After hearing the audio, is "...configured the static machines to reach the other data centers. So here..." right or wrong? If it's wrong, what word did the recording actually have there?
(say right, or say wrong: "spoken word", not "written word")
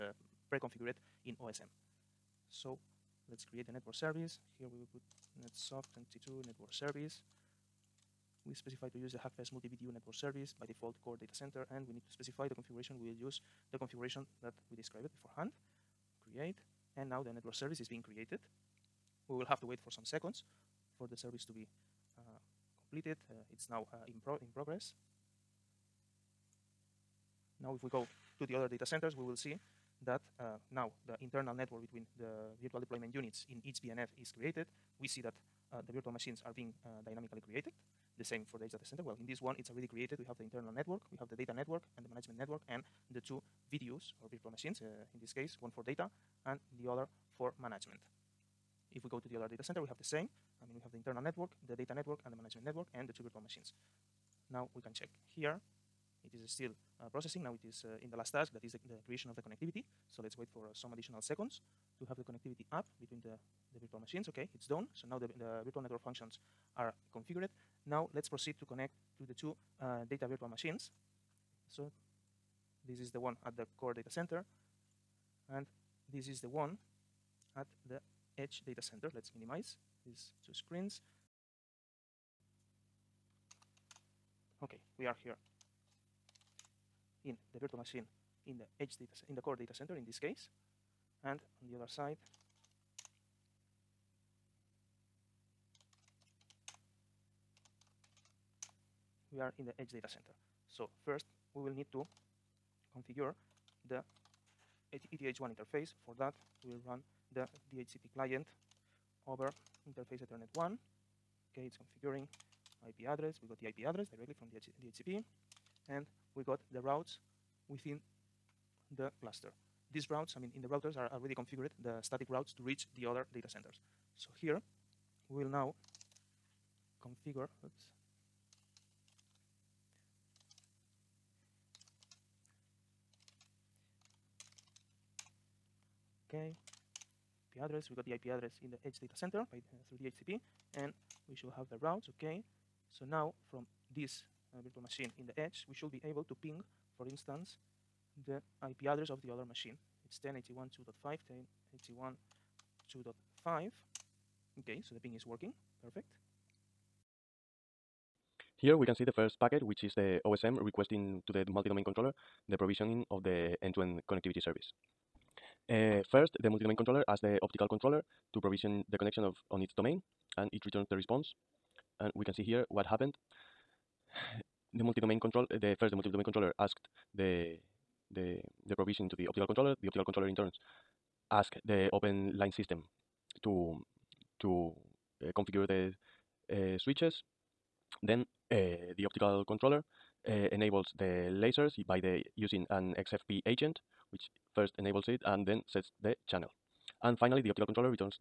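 wrong: "routes", not "machines".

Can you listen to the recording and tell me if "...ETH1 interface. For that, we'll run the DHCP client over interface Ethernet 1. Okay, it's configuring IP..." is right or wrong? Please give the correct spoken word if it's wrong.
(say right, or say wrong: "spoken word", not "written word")
right.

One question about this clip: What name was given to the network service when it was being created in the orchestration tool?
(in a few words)
netsoft 22.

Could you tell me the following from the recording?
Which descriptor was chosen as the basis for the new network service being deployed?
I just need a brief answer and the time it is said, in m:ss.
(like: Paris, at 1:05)
Hackfest multi VDU, at 0:09.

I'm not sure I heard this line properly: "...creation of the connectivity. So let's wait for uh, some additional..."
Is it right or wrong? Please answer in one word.
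right.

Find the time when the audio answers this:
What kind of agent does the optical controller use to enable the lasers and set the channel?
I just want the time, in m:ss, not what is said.
3:12.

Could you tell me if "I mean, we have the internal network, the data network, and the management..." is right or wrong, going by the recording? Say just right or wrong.
right.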